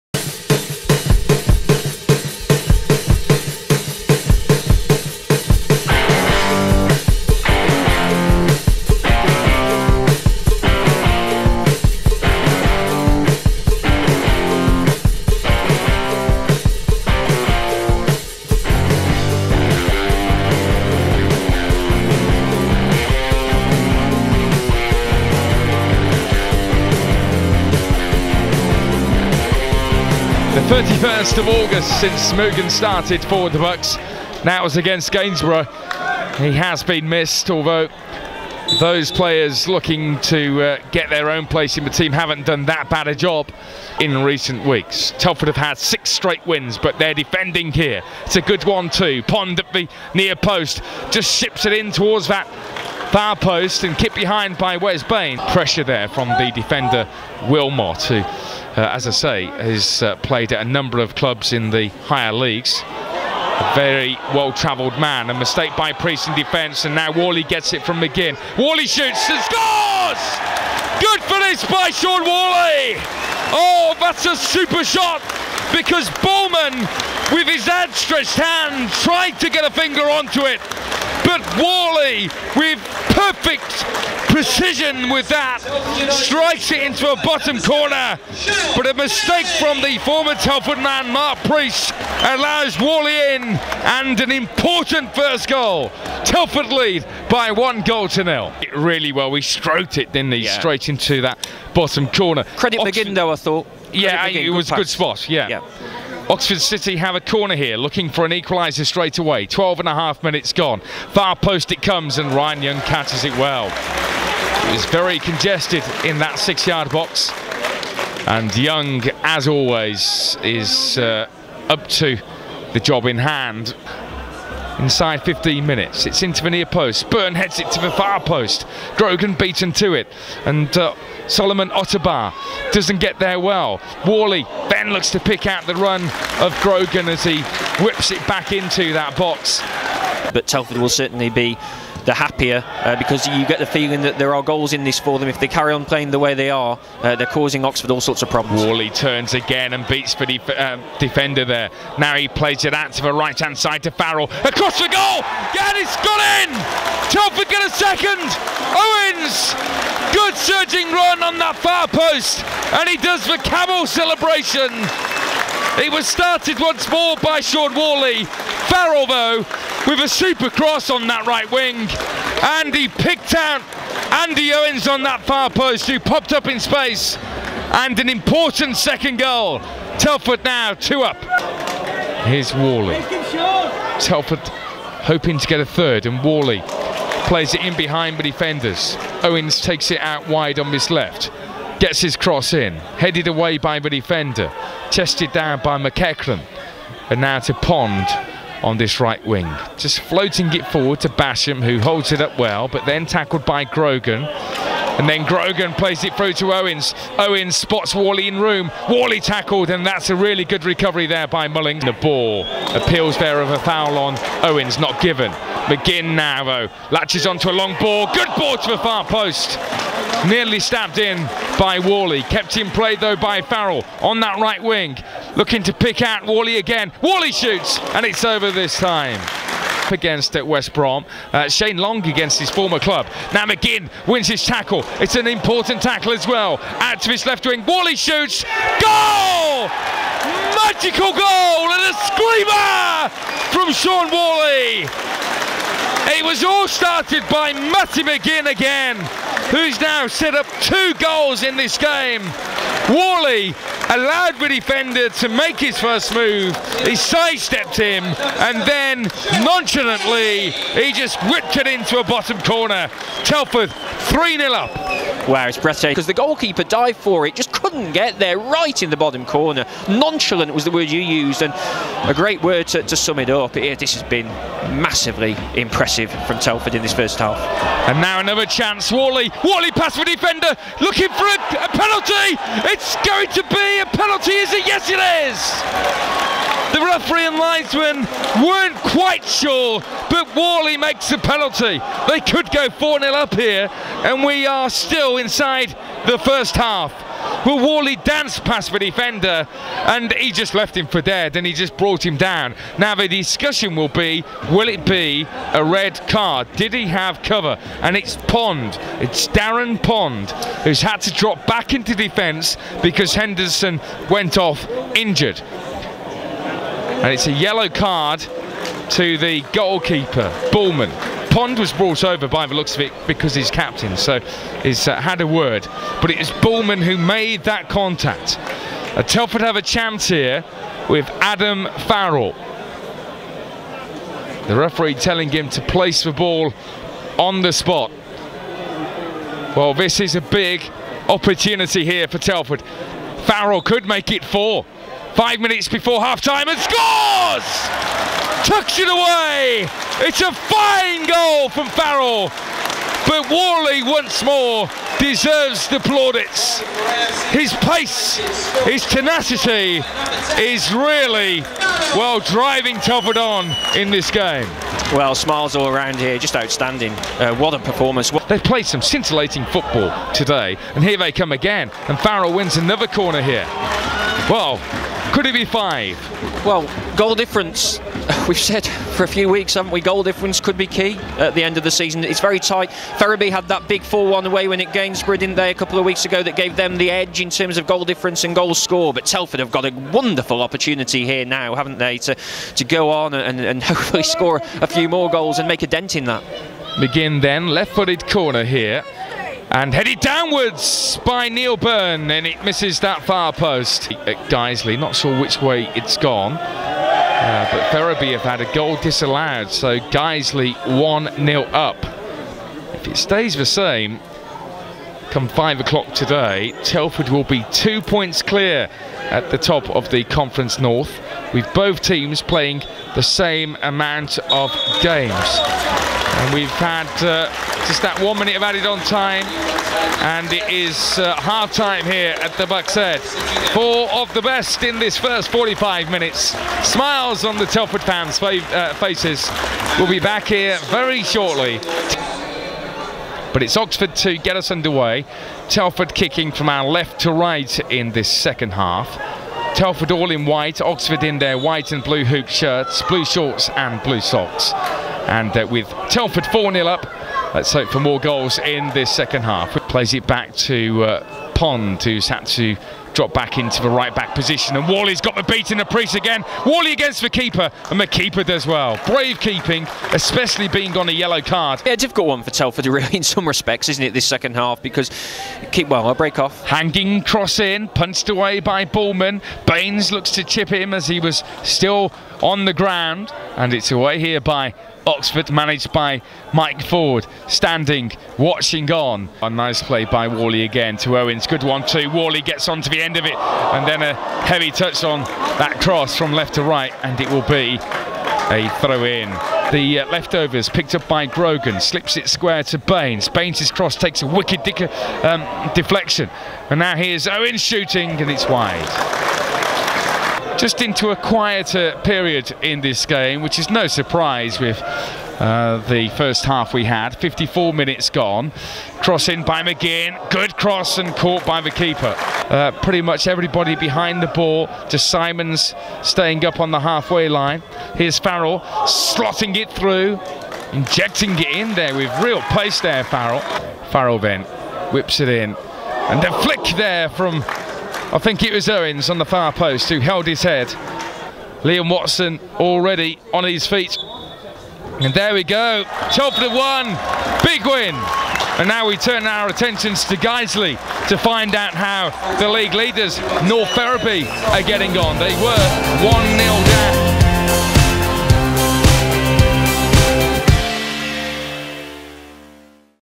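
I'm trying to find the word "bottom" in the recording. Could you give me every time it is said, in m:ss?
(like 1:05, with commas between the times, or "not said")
1:27, 1:41, 4:22, 4:28.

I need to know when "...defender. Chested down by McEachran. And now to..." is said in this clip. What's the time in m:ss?
3:13.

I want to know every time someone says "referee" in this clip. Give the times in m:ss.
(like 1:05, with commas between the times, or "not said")
4:46, 5:34.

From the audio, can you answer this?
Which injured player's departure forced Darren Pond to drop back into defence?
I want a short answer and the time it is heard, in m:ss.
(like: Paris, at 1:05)
Henderson, at 5:13.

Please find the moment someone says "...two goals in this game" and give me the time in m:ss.
4:10.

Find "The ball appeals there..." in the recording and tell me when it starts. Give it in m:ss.
3:31.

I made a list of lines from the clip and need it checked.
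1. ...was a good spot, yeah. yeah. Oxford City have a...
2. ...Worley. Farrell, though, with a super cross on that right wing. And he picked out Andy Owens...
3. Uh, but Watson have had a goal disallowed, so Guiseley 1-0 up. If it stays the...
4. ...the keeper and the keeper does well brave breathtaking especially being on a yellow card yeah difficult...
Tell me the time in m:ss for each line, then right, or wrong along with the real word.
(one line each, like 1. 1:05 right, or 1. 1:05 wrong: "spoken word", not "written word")
1. 1:44 right
2. 2:47 right
3. 6:47 wrong: "Ferriby", not "Watson"
4. 7:47 wrong: "keeping", not "breathtaking".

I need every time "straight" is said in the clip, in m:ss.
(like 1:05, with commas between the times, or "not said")
0:46, 1:40, 1:48.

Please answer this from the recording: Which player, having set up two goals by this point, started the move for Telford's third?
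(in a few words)
Matty McGinn.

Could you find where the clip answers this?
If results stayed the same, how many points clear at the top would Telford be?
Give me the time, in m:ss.
6:57.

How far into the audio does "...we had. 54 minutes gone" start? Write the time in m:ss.
8:36.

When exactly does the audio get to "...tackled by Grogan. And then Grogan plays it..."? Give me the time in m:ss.
3:23.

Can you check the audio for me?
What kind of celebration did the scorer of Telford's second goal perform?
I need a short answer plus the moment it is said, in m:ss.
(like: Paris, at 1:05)
camel celebration, at 2:43.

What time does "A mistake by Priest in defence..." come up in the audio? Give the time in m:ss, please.
1:05.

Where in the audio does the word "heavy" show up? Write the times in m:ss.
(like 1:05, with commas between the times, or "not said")
8:14.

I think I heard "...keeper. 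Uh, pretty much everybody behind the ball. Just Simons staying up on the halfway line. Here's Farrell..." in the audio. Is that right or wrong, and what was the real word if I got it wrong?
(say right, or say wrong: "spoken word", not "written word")
right.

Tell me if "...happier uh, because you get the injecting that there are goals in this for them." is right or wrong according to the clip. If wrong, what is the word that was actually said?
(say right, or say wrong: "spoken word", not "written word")
wrong: "feeling", not "injecting".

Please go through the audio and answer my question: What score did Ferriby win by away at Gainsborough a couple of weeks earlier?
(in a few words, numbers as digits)
4-1.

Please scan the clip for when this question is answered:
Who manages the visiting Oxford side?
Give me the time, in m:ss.
8:06.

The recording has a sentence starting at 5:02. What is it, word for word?
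Now, the discussion will be will it be a red card?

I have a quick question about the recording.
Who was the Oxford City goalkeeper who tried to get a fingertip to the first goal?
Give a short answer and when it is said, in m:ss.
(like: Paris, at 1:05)
Bowman, at 1:16.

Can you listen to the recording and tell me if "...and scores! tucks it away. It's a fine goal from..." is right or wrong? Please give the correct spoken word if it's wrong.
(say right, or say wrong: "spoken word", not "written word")
right.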